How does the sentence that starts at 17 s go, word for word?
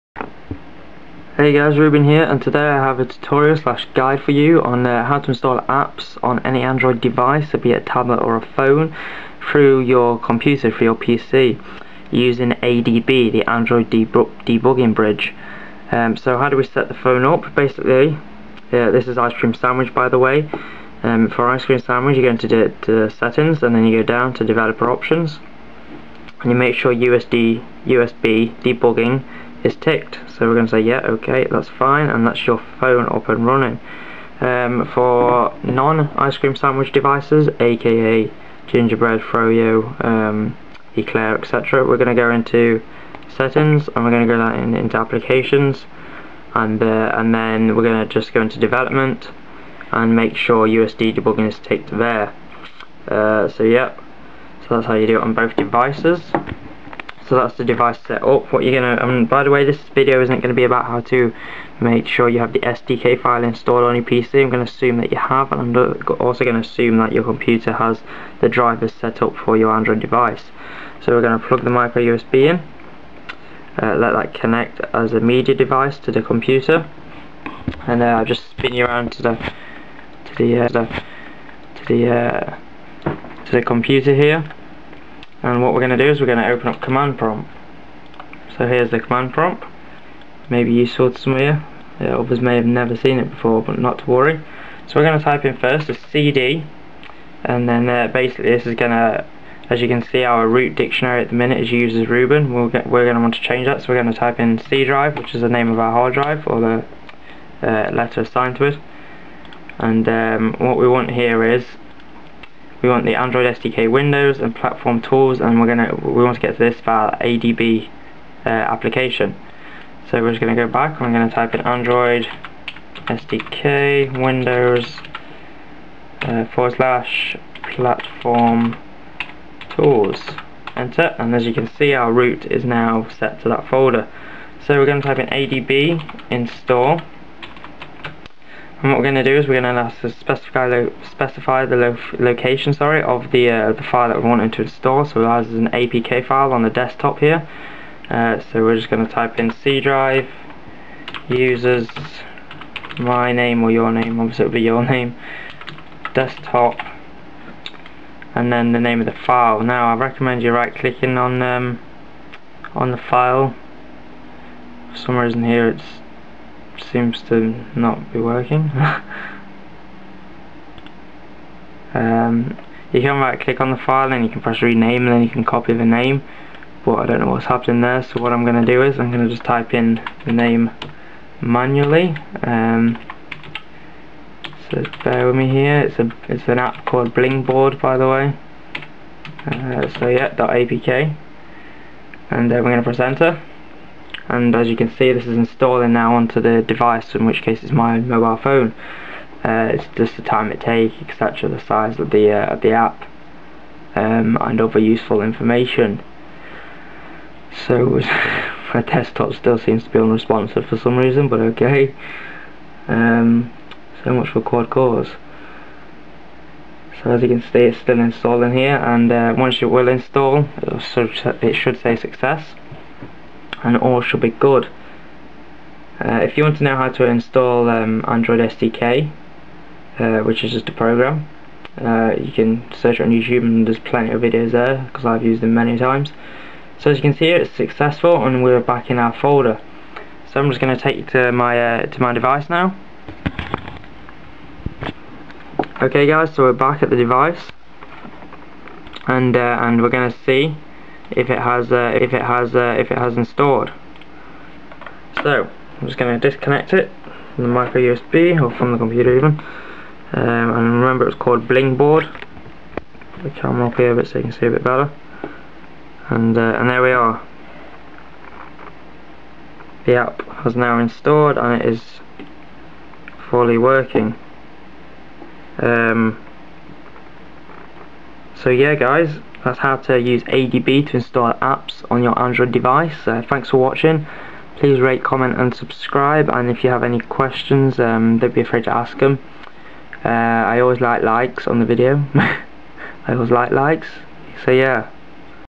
Basically, uh, this is ice cream sandwich by the way.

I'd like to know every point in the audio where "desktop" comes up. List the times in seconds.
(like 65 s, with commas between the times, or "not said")
146 s, 156 s, 208 s.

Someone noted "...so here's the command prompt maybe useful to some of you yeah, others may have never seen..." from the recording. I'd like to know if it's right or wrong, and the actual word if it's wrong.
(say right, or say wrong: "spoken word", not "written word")
right.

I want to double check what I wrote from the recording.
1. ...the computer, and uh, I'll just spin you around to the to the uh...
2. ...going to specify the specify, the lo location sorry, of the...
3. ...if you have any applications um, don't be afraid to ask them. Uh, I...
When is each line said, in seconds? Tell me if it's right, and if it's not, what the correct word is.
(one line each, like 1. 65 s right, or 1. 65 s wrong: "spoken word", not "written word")
1. 76 s right
2. 139 s right
3. 286 s wrong: "questions", not "applications".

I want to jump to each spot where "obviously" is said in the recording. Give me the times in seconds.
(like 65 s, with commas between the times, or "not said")
154 s.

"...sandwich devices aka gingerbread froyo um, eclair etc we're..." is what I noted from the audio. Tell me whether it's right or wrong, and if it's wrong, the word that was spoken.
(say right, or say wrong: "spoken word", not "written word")
right.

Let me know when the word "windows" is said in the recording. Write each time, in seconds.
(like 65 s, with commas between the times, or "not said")
113 s, 124 s.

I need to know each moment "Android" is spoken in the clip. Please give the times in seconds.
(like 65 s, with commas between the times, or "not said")
6 s, 13 s, 69 s, 113 s, 121 s, 228 s, 282 s.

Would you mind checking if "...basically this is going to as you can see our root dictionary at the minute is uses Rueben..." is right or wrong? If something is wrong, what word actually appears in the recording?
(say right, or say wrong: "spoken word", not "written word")
right.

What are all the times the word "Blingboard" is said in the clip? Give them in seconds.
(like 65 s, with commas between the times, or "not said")
187 s, 261 s.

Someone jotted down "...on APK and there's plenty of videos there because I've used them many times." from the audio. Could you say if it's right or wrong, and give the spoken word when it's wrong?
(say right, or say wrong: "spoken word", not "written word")
wrong: "YouTube", not "APK".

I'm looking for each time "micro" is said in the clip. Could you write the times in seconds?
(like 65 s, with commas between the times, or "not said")
71 s, 257 s.